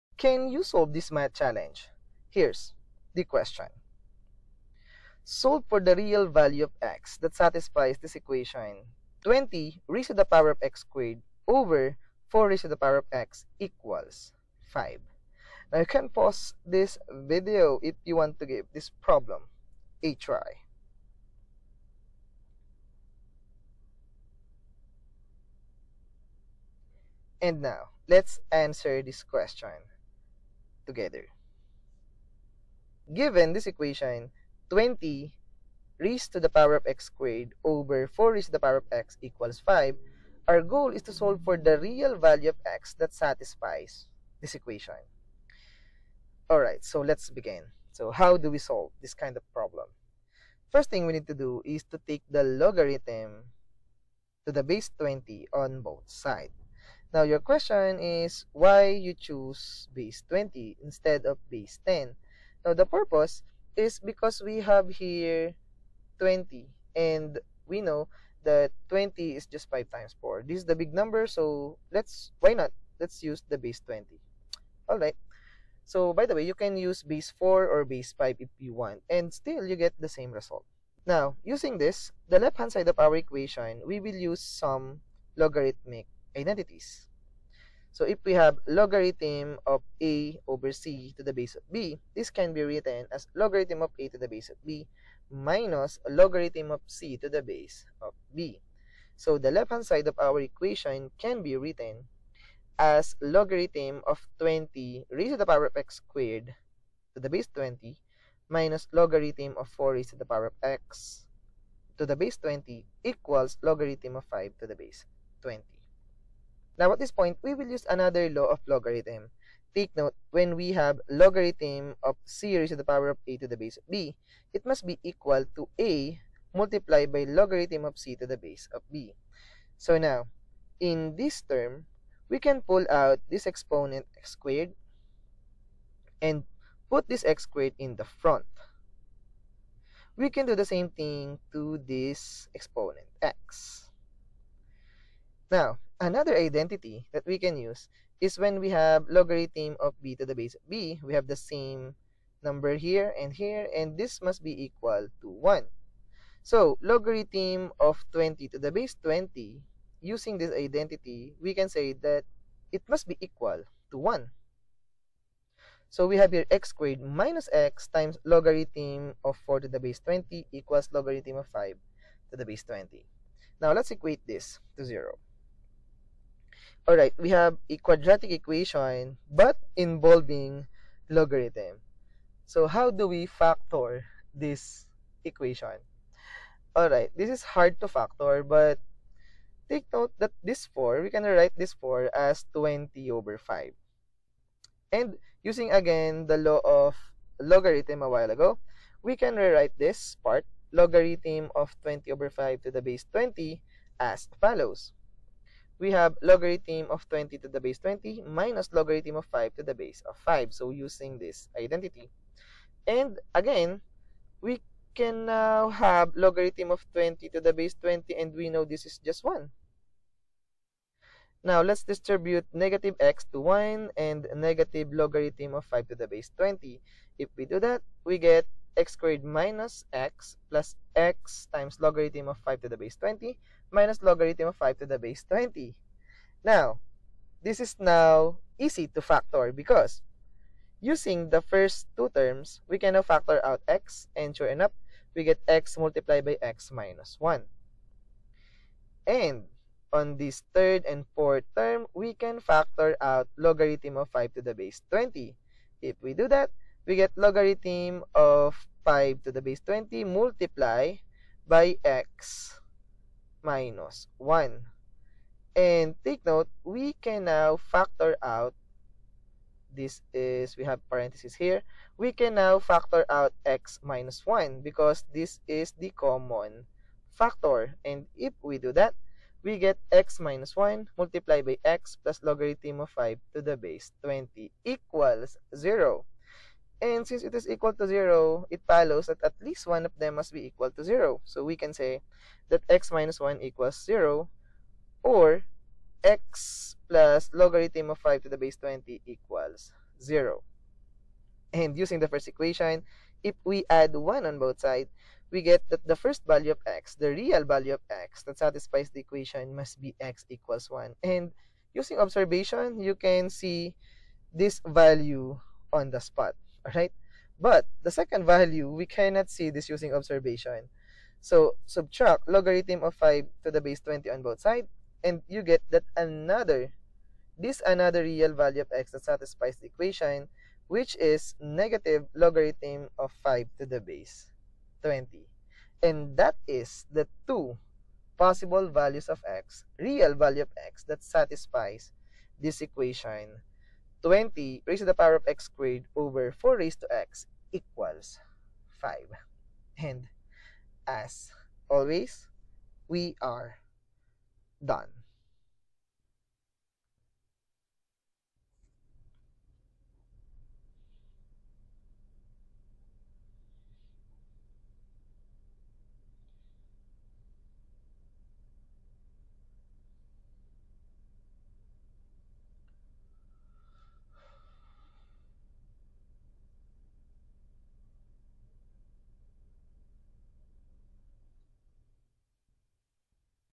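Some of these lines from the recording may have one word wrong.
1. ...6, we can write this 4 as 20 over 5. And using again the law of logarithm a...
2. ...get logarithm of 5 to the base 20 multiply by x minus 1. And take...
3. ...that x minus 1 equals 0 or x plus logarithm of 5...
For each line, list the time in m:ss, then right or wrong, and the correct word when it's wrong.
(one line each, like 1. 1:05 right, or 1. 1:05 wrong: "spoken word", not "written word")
1. 3:10 wrong: "4", not "6"
2. 4:16 right
3. 4:52 right.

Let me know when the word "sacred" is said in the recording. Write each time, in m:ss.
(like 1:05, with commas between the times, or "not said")
not said.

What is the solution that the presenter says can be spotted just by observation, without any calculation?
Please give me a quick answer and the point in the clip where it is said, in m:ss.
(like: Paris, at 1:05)
x = 1, at 5:09.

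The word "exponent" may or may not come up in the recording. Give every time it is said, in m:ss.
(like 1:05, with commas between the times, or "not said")
2:13, 2:22.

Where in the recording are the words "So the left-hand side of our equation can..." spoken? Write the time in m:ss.
1:39.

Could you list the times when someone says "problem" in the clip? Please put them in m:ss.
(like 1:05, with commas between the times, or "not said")
0:19, 0:49.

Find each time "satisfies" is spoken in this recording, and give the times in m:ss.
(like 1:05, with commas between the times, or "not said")
0:07, 0:43, 5:08, 5:29, 5:41.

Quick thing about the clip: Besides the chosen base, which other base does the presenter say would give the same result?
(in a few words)
base 4.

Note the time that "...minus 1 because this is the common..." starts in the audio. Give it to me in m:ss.
4:33.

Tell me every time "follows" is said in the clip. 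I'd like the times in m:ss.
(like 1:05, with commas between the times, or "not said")
3:24, 4:48.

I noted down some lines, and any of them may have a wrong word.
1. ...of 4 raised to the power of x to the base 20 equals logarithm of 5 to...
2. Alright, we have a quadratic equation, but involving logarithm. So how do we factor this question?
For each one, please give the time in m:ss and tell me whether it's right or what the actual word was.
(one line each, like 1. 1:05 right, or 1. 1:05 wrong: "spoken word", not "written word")
1. 1:49 right
2. 2:56 wrong: "equation", not "question".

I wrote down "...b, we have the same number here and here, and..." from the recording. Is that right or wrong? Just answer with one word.
right.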